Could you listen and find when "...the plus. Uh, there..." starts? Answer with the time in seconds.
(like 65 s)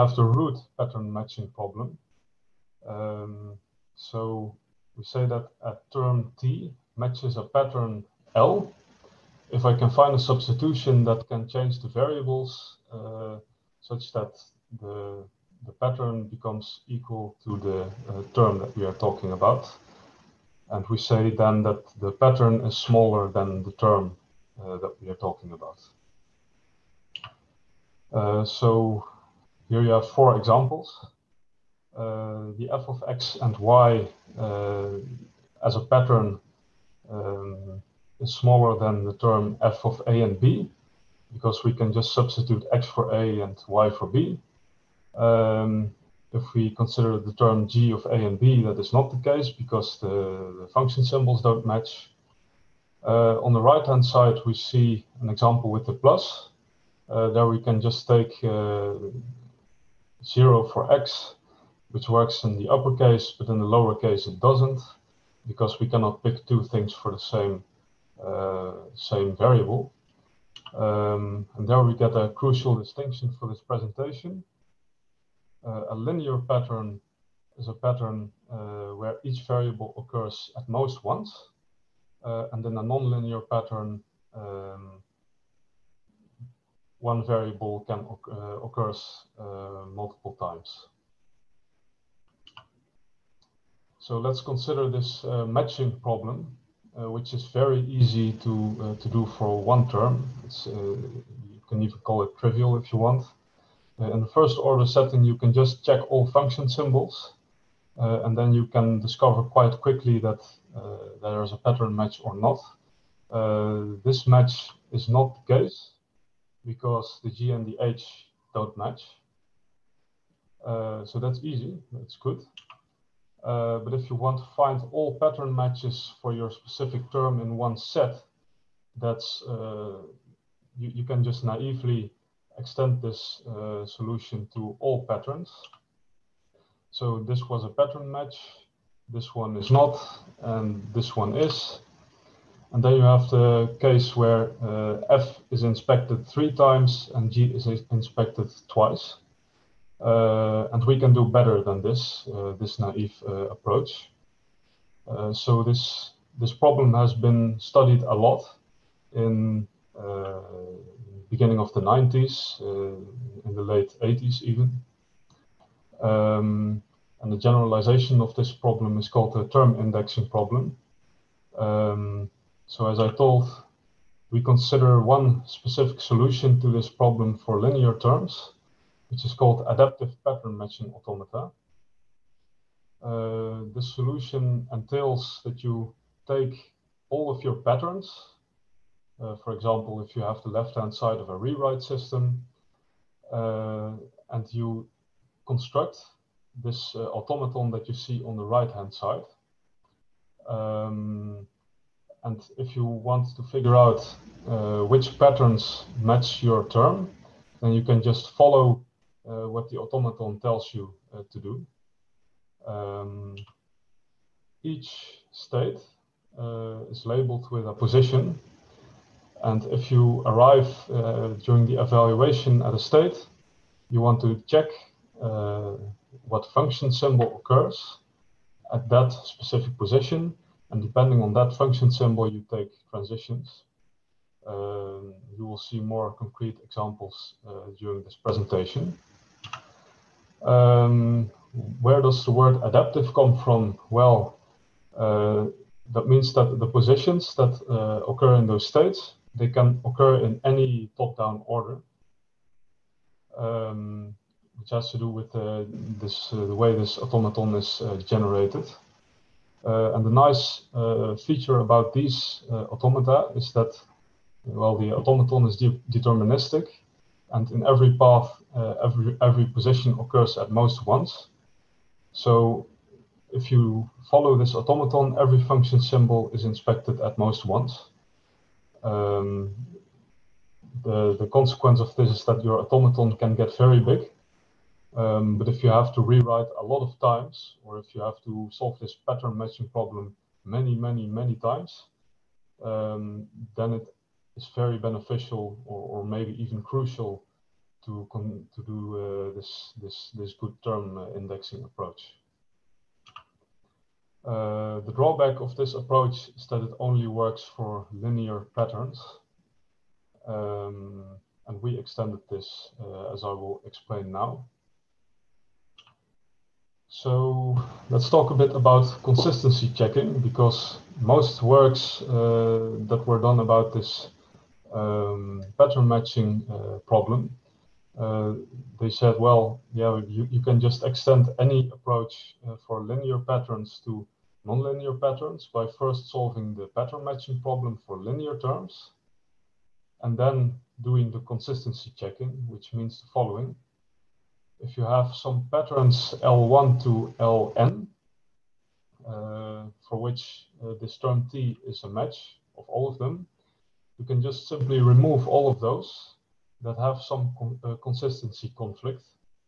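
55 s.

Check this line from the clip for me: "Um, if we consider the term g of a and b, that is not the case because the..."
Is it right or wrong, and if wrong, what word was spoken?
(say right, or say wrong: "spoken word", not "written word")
right.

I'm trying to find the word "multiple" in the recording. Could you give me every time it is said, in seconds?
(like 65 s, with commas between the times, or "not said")
89 s.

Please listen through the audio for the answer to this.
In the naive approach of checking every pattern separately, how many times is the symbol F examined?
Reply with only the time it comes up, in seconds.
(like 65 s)
146 s.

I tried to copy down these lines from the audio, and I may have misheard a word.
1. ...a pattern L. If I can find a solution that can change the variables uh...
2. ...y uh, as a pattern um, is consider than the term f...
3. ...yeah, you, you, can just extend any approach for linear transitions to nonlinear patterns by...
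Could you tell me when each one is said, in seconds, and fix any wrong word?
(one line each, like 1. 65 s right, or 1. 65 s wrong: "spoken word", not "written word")
1. 7 s wrong: "substitution", not "solution"
2. 33 s wrong: "smaller", not "consider"
3. 329 s wrong: "patterns", not "transitions".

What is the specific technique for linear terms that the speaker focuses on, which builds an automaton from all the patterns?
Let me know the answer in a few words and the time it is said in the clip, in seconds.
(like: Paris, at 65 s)
adaptive pattern matching automata, at 179 s.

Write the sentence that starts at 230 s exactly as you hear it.
And depending on that function symbol, you take transitions.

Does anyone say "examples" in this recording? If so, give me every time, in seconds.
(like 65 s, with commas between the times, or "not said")
30 s, 55 s, 189 s, 236 s.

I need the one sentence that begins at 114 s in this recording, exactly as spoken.
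this match is not the case because the G and the H don't match.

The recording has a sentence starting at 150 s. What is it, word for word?
Uh, and we can do better than this, uh, this naive uh, approach.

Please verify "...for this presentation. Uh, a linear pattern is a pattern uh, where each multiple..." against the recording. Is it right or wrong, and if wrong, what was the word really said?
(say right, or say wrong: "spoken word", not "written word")
wrong: "variable", not "multiple".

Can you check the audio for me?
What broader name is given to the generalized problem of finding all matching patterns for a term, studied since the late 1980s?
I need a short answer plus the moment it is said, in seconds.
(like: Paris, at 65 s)
term indexing problem, at 169 s.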